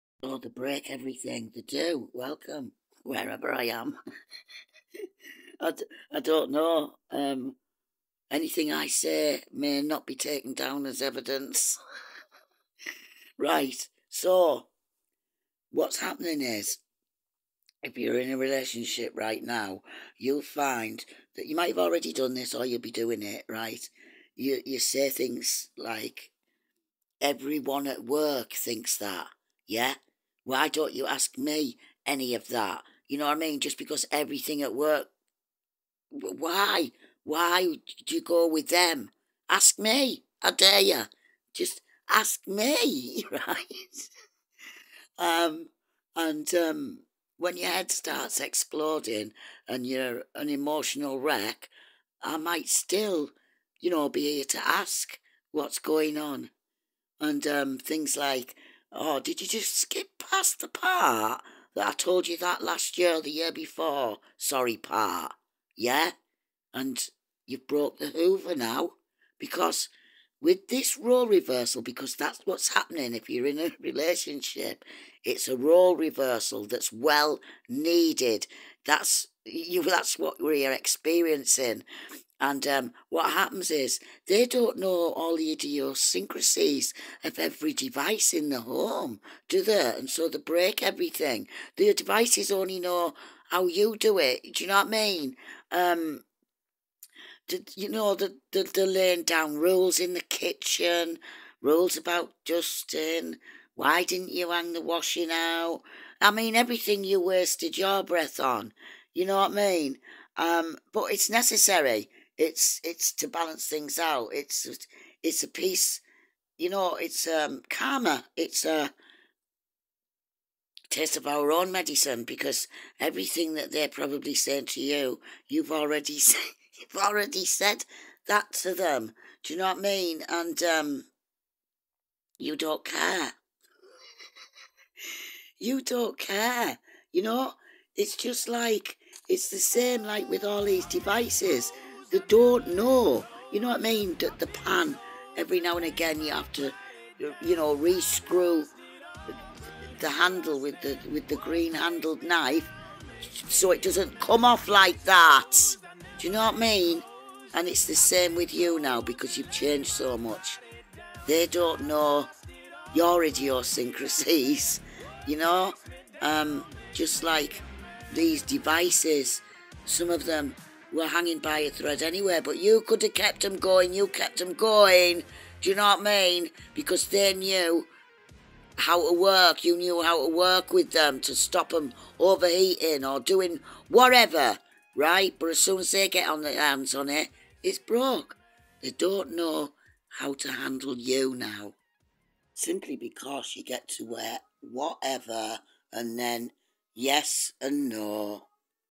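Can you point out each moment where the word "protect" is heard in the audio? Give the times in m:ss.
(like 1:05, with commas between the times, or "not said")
not said.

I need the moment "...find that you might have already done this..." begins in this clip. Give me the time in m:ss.
0:20.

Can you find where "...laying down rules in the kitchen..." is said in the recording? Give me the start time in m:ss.
1:38.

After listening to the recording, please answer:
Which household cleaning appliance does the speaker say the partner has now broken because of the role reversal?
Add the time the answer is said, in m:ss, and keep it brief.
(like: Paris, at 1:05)
hoover, at 1:08.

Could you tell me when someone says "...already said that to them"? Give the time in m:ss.
2:07.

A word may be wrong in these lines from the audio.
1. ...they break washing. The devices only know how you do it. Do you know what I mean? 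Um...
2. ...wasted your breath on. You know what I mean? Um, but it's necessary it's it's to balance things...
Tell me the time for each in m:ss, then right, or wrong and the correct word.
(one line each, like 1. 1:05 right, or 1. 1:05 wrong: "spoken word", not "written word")
1. 1:30 wrong: "everything", not "washing"
2. 1:47 right.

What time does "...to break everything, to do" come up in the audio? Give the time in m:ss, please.
0:00.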